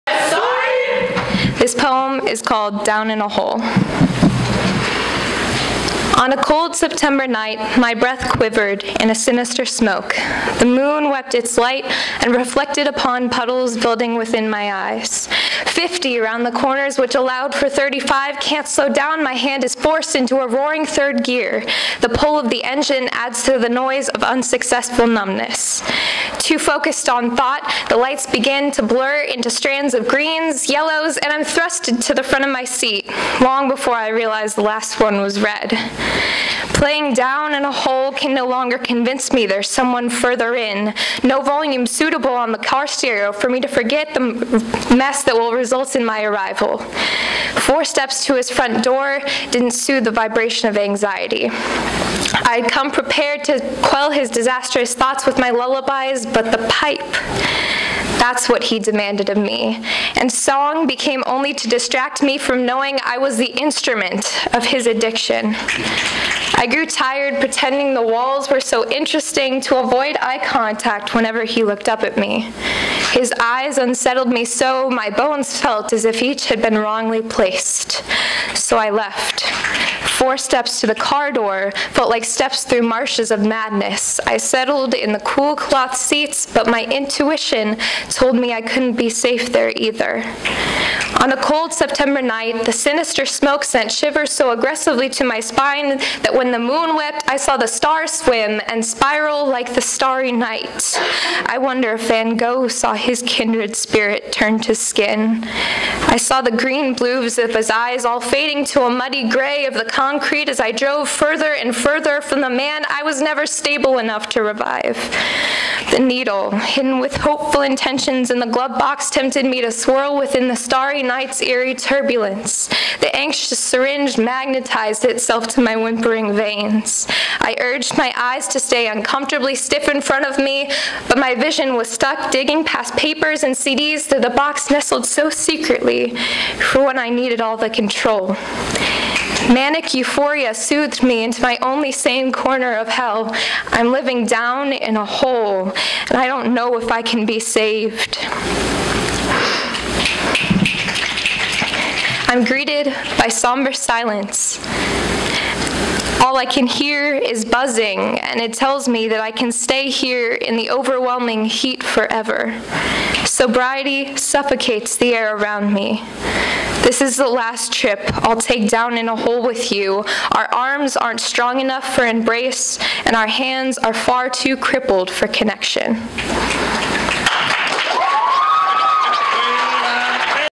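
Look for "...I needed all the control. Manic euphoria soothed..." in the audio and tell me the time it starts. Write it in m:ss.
2:16.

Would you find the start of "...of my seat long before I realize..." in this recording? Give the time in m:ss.
0:32.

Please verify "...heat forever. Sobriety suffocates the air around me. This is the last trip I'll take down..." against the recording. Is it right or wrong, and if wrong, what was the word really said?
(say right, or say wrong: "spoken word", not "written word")
right.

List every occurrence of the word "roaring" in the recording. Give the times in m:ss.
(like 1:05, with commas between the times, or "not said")
0:20.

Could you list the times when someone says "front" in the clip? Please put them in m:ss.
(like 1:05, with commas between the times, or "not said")
0:32, 0:48, 2:10.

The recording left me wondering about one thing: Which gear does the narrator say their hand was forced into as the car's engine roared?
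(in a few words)
Third gear.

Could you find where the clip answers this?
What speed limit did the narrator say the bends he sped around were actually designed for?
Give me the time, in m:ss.
0:17.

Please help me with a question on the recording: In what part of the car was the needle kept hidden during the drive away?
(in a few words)
Glove box.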